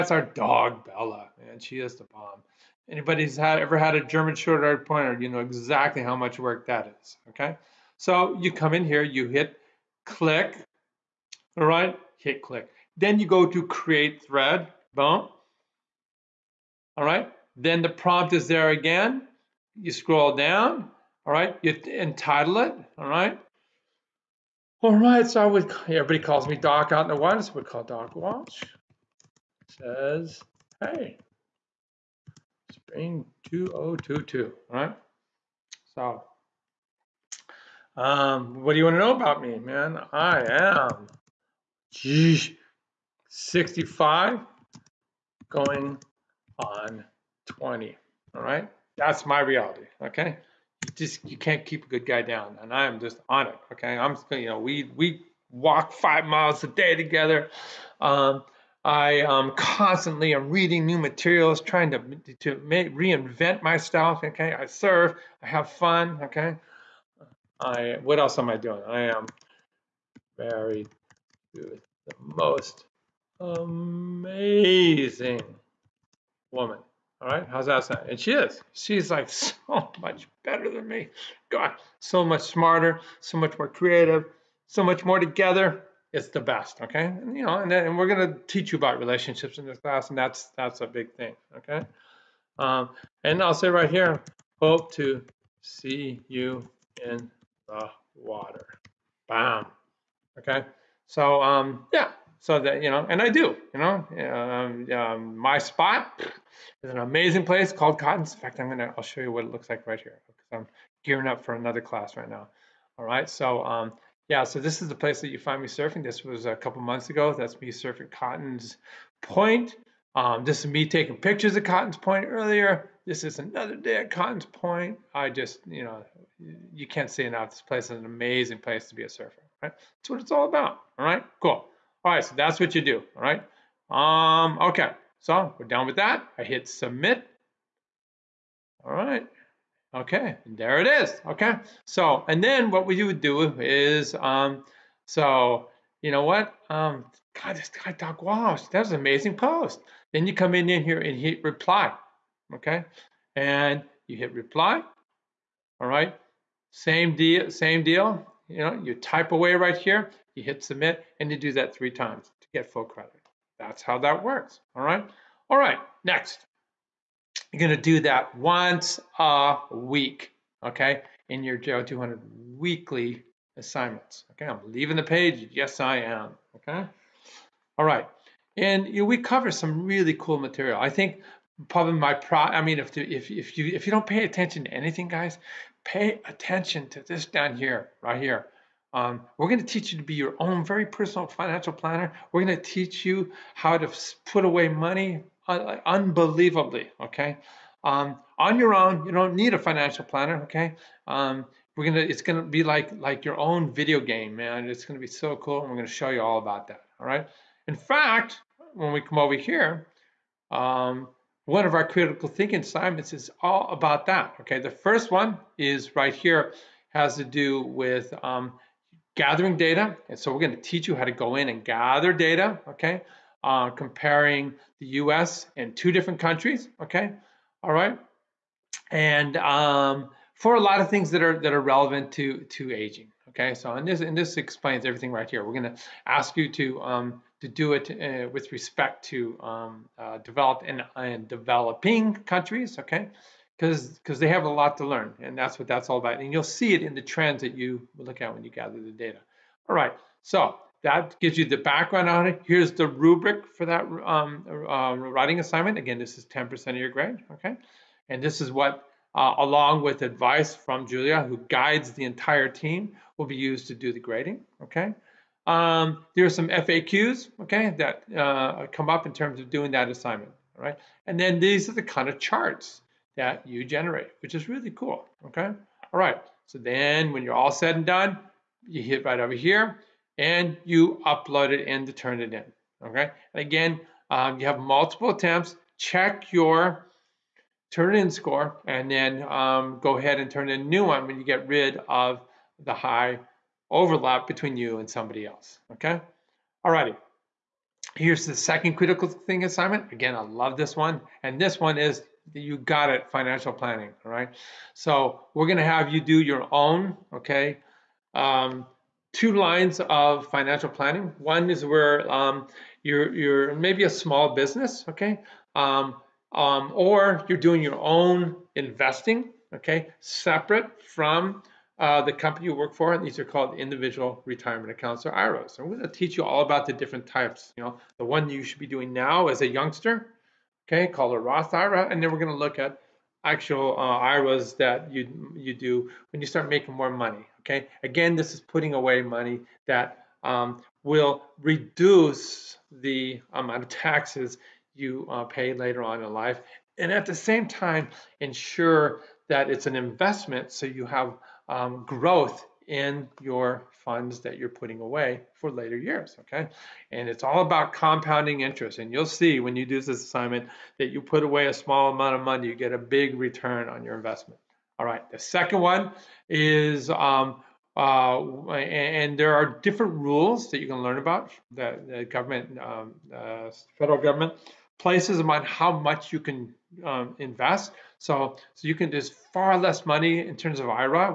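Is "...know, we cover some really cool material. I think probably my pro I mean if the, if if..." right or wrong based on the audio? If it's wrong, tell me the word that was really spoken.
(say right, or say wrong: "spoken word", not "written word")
right.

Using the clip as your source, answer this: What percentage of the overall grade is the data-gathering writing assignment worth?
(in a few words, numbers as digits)
10%.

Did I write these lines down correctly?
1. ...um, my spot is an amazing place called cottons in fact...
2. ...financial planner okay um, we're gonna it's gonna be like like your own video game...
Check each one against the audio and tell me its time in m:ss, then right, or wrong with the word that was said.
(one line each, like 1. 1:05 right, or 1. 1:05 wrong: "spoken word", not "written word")
1. 1:44 right
2. 3:19 right.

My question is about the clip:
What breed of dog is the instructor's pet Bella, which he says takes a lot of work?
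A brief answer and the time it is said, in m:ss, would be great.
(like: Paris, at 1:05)
German short haired pointer, at 0:04.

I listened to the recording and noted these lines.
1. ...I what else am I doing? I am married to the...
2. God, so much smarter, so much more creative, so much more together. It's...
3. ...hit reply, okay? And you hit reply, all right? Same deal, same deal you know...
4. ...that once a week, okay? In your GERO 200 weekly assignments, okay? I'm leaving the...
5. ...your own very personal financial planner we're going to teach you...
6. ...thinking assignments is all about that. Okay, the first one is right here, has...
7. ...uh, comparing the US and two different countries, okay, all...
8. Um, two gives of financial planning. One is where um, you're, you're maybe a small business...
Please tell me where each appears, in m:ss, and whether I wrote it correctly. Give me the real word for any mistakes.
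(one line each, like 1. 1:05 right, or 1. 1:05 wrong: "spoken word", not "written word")
1. 1:07 right
2. 1:21 right
3. 2:31 right
4. 2:48 right
5. 3:10 right
6. 3:32 right
7. 3:43 right
8. 5:08 wrong: "lines", not "gives".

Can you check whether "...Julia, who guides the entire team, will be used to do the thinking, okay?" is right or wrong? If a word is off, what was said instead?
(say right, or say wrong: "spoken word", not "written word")
wrong: "grading", not "thinking".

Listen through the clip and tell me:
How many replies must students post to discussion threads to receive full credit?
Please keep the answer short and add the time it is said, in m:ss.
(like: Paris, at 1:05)
3, at 2:41.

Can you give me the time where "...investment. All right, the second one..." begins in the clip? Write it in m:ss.
6:03.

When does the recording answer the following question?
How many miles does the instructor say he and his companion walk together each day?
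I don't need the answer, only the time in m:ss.
0:55.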